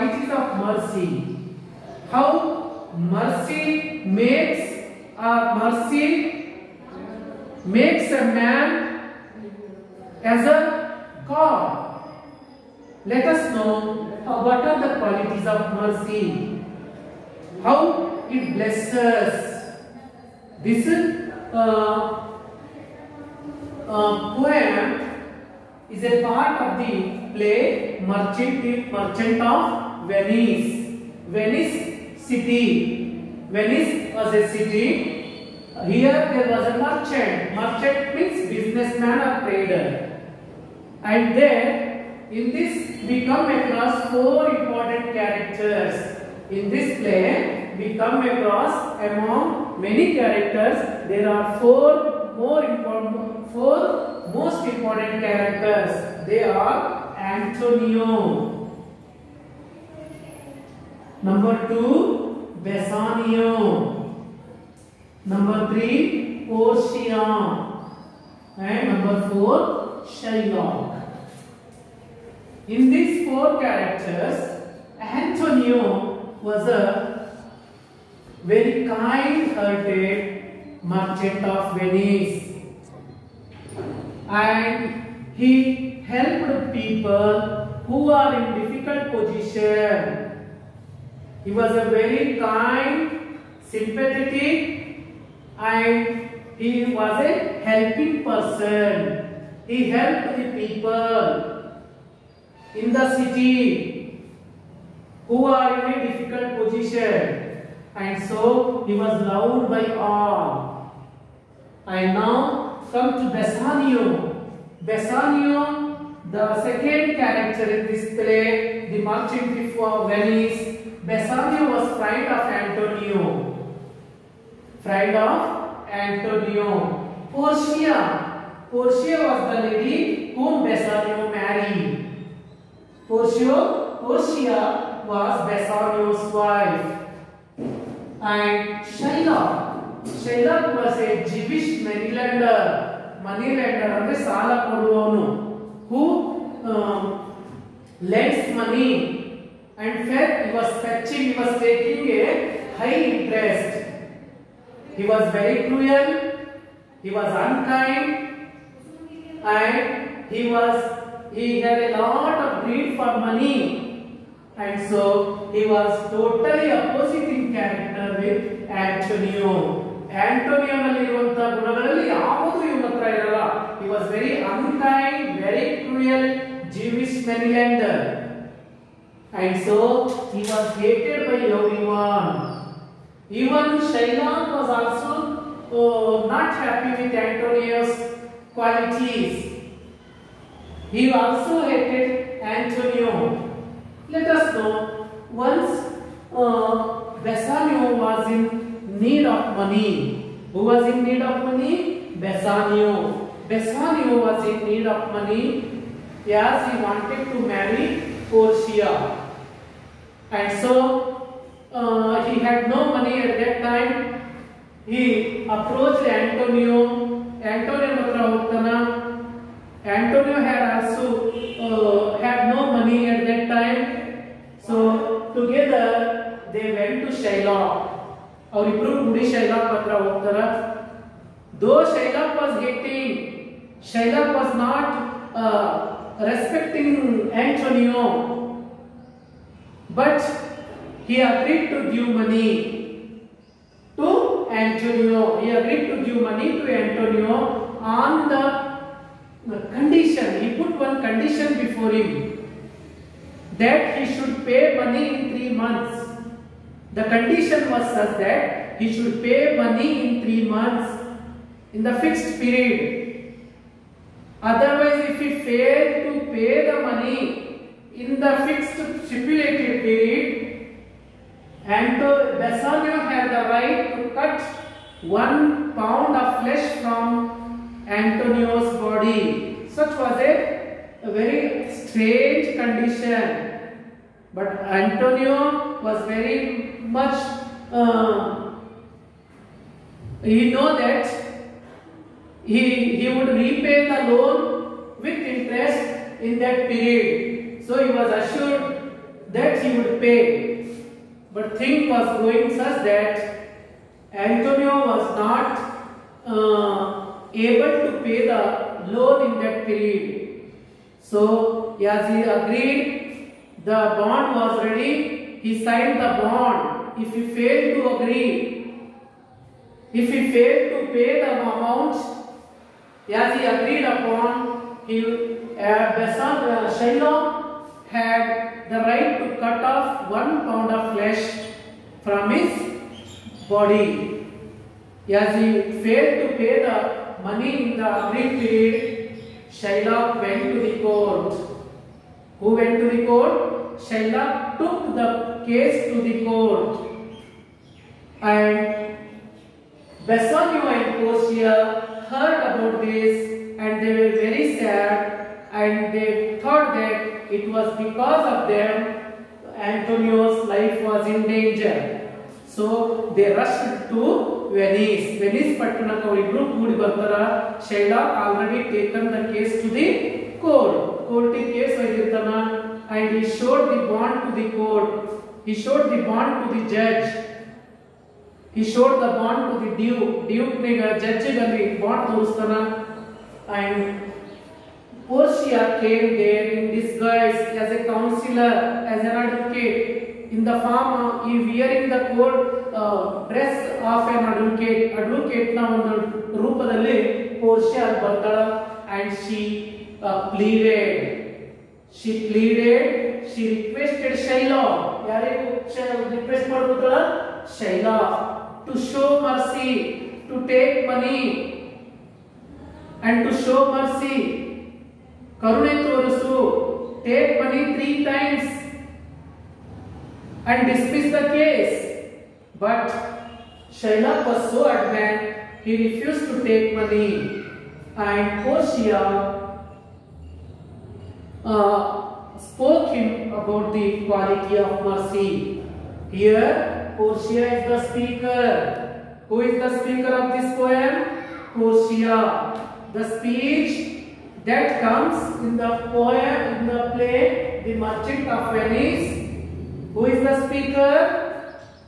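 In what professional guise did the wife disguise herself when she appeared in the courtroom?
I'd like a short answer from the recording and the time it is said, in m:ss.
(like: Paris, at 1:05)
counselor, at 6:27.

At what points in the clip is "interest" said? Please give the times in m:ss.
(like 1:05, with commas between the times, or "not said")
2:33, 4:55.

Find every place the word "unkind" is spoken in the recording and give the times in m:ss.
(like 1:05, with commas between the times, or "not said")
2:37, 2:54.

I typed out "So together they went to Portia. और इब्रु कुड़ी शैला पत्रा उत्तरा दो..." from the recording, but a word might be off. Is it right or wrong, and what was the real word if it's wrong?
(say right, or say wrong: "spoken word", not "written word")
wrong: "Shailoh", not "Portia".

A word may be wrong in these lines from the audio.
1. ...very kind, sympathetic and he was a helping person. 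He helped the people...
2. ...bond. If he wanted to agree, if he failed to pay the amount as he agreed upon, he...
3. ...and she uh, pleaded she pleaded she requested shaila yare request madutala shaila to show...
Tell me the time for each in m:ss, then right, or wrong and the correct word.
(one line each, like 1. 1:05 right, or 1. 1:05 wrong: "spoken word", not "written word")
1. 1:31 right
2. 5:16 wrong: "failed", not "wanted"
3. 6:38 right.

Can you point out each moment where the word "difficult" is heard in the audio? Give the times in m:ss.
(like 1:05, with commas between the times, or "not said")
1:28, 1:46.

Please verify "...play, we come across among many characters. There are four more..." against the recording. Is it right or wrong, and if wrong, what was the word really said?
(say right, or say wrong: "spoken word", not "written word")
right.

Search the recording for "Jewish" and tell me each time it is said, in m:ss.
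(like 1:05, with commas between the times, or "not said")
2:21, 2:56.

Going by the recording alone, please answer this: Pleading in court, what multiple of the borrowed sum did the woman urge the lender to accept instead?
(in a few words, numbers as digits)
three times.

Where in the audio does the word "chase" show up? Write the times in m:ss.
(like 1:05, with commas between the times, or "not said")
not said.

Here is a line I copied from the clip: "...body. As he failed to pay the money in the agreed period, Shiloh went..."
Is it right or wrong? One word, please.
right.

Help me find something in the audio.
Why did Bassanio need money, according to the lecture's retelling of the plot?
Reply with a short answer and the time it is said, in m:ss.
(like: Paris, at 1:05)
to marry Portia, at 3:27.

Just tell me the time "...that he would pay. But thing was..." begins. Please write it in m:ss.
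4:59.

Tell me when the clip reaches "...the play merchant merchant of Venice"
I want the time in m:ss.
0:26.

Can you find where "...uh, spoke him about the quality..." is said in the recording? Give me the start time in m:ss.
7:11.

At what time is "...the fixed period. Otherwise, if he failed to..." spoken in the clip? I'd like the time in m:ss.
4:21.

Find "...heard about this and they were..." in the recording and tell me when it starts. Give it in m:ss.
5:52.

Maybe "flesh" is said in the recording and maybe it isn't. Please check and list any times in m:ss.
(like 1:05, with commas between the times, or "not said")
4:36, 5:30.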